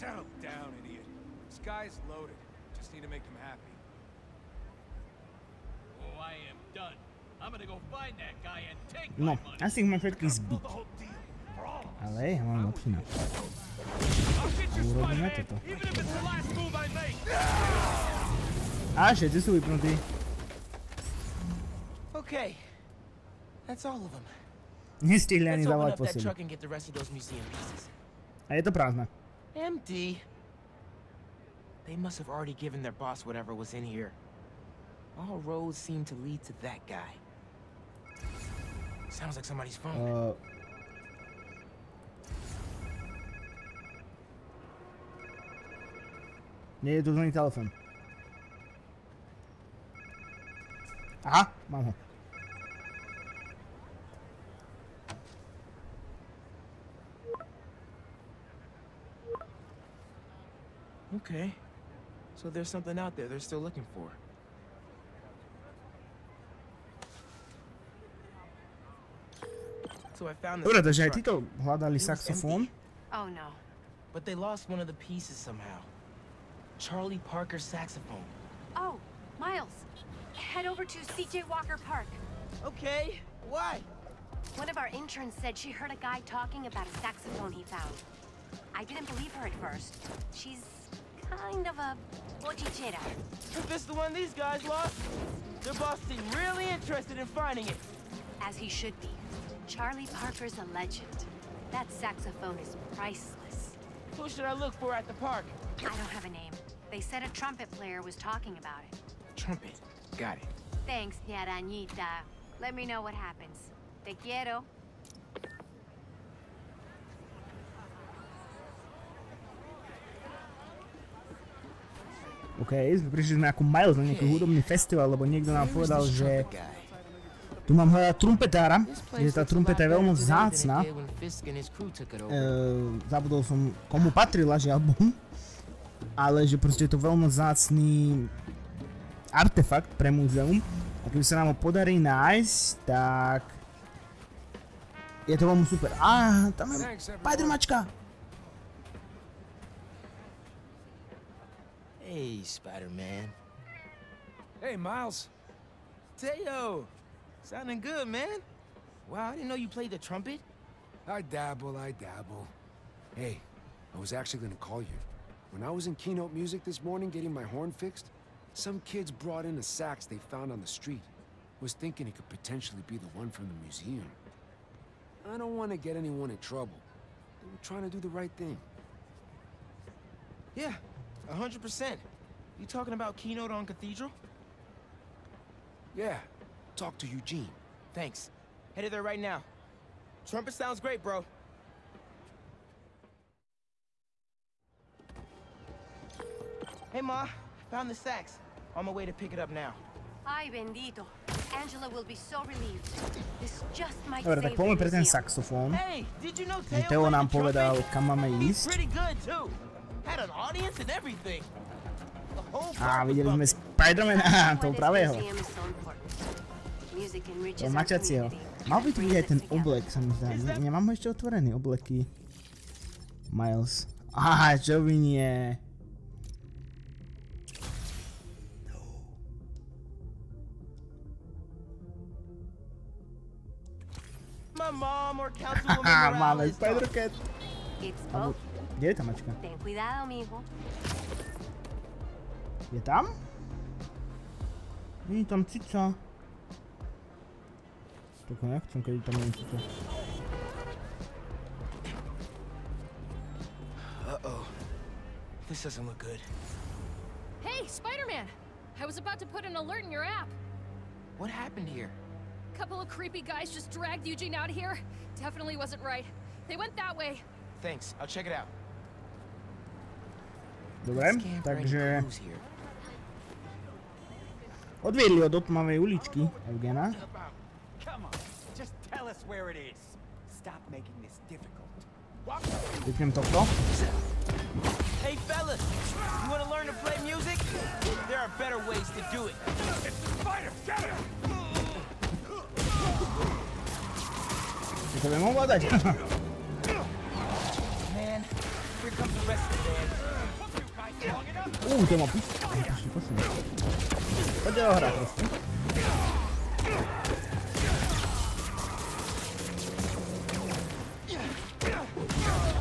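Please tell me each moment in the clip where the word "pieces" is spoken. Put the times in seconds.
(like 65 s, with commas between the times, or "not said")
74 s.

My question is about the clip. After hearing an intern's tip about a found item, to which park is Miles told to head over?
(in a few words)
CJ Walker Park.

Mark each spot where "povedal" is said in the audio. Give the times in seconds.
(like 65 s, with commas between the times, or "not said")
125 s, 207 s.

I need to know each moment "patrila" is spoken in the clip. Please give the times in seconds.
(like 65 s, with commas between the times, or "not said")
134 s.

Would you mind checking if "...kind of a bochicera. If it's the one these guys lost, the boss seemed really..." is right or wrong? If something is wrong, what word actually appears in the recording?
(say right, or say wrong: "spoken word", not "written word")
right.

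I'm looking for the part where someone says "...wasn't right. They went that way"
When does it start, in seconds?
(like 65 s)
265 s.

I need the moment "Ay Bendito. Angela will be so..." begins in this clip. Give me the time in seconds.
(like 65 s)
200 s.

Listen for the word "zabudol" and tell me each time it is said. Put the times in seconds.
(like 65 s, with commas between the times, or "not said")
133 s.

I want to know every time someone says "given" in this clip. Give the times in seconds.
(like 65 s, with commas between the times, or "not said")
32 s.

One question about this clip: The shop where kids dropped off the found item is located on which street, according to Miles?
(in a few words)
Cathedral.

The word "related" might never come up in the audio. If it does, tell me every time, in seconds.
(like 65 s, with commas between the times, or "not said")
not said.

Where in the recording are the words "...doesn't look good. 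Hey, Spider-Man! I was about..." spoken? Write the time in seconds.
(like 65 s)
255 s.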